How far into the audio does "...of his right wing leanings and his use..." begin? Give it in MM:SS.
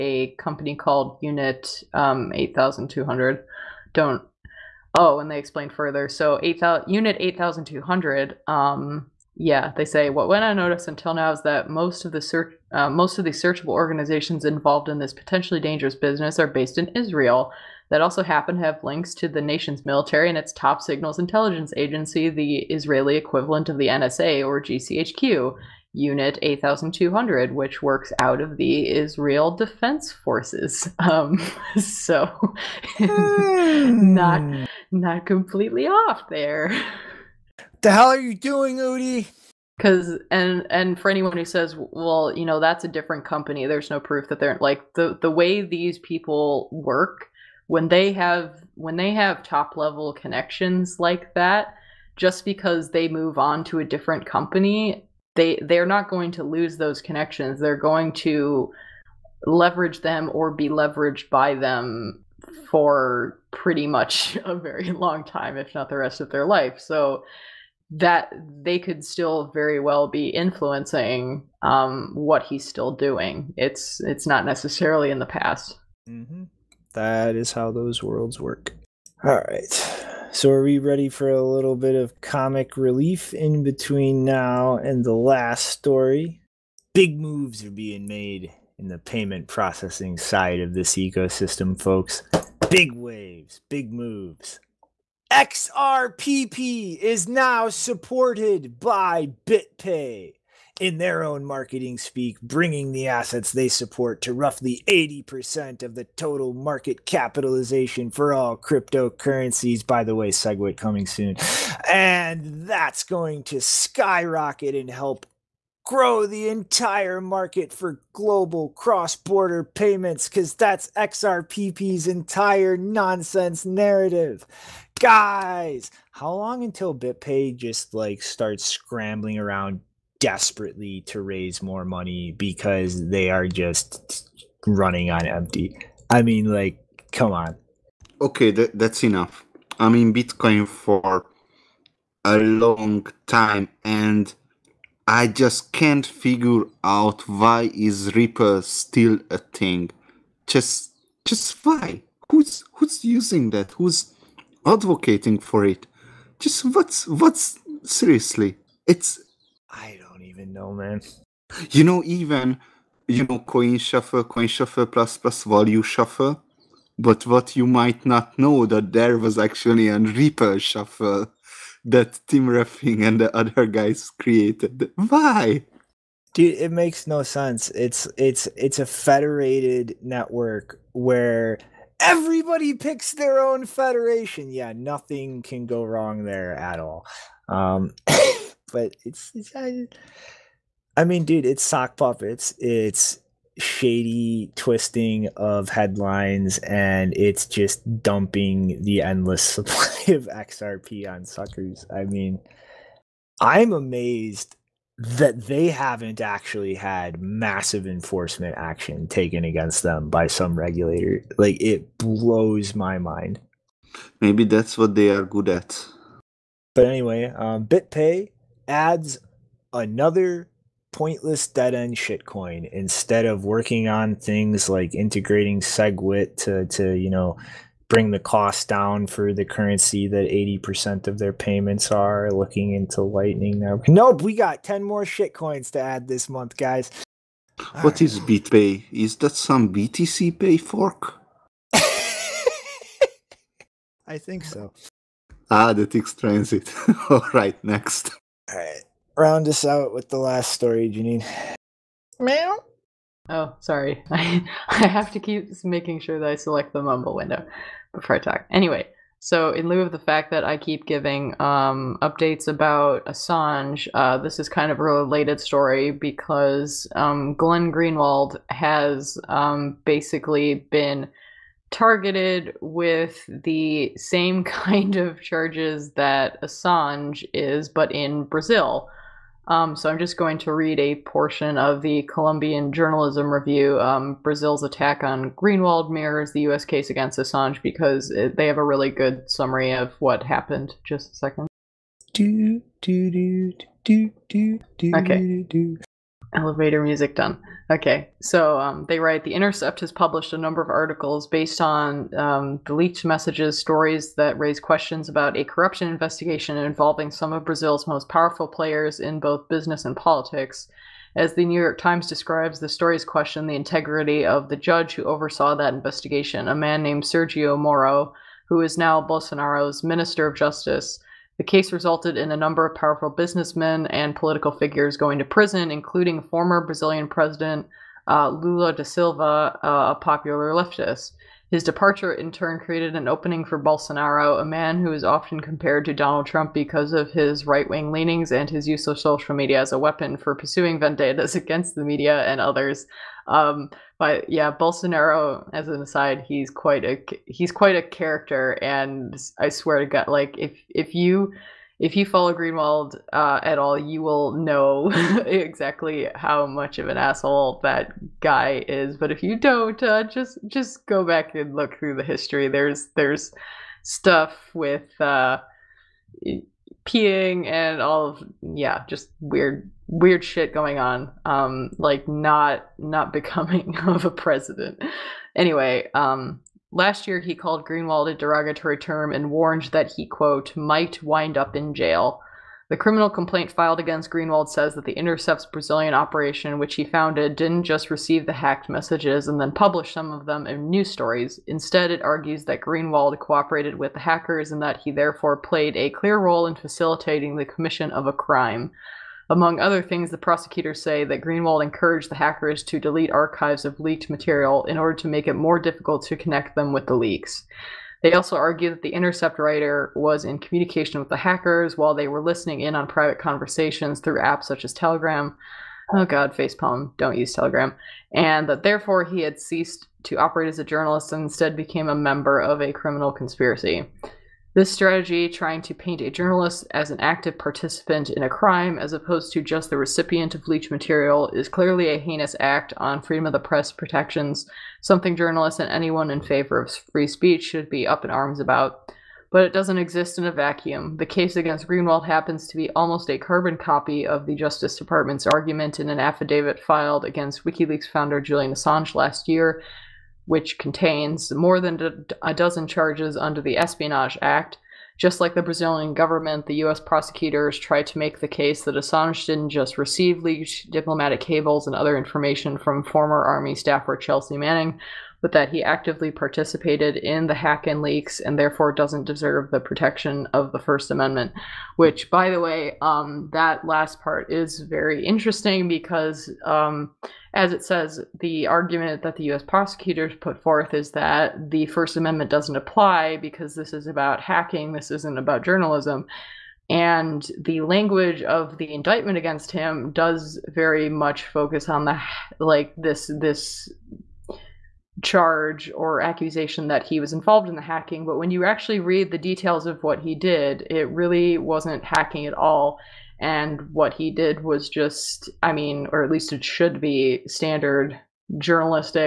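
05:36.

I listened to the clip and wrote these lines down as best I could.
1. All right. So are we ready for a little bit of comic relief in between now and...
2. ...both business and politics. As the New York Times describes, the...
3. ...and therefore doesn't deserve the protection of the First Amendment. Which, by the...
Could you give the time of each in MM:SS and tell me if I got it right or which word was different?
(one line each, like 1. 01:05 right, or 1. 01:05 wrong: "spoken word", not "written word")
1. 01:19 right
2. 05:09 right
3. 07:48 right.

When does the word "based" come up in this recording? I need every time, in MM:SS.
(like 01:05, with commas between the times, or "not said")
00:16, 05:01.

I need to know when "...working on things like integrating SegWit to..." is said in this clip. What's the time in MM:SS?
03:43.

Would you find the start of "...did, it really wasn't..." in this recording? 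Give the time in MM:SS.
08:20.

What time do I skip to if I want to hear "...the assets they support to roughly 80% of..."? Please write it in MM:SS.
01:42.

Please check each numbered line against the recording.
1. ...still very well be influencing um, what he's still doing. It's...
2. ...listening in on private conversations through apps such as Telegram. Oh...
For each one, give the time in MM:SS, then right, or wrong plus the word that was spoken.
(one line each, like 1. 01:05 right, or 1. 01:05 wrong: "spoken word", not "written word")
1. 01:09 right
2. 06:52 right.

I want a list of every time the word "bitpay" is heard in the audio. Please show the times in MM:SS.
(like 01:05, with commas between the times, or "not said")
01:39, 02:06, 03:37, 03:58.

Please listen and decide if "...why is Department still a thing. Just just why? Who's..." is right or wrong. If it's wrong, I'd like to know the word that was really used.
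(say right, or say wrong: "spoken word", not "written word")
wrong: "Ripple", not "Department".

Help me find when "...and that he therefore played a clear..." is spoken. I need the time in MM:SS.
06:34.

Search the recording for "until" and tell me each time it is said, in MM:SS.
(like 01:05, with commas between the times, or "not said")
00:10, 02:06.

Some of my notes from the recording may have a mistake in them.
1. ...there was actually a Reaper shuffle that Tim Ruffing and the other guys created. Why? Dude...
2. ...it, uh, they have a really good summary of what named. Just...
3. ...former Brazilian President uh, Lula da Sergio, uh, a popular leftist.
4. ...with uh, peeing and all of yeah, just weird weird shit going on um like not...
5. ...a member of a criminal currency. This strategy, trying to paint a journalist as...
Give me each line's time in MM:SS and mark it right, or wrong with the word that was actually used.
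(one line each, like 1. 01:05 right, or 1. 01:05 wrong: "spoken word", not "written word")
1. 02:48 right
2. 04:48 wrong: "happened", not "named"
3. 05:26 wrong: "Silva", not "Sergio"
4. 06:04 right
5. 07:01 wrong: "conspiracy", not "currency".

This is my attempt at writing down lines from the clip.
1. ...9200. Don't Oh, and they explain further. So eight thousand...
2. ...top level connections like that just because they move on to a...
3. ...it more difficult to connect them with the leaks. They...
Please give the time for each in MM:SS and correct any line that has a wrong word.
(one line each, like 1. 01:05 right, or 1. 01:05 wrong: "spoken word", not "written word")
1. 00:02 wrong: "8200", not "9200"
2. 00:49 right
3. 06:45 right.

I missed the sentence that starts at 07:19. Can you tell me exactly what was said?
But it doesn't exist in a vacuum.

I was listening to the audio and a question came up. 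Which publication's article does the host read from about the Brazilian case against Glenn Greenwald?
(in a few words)
Columbia Journalism Review.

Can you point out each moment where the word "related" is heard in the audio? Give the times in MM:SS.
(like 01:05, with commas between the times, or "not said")
04:24.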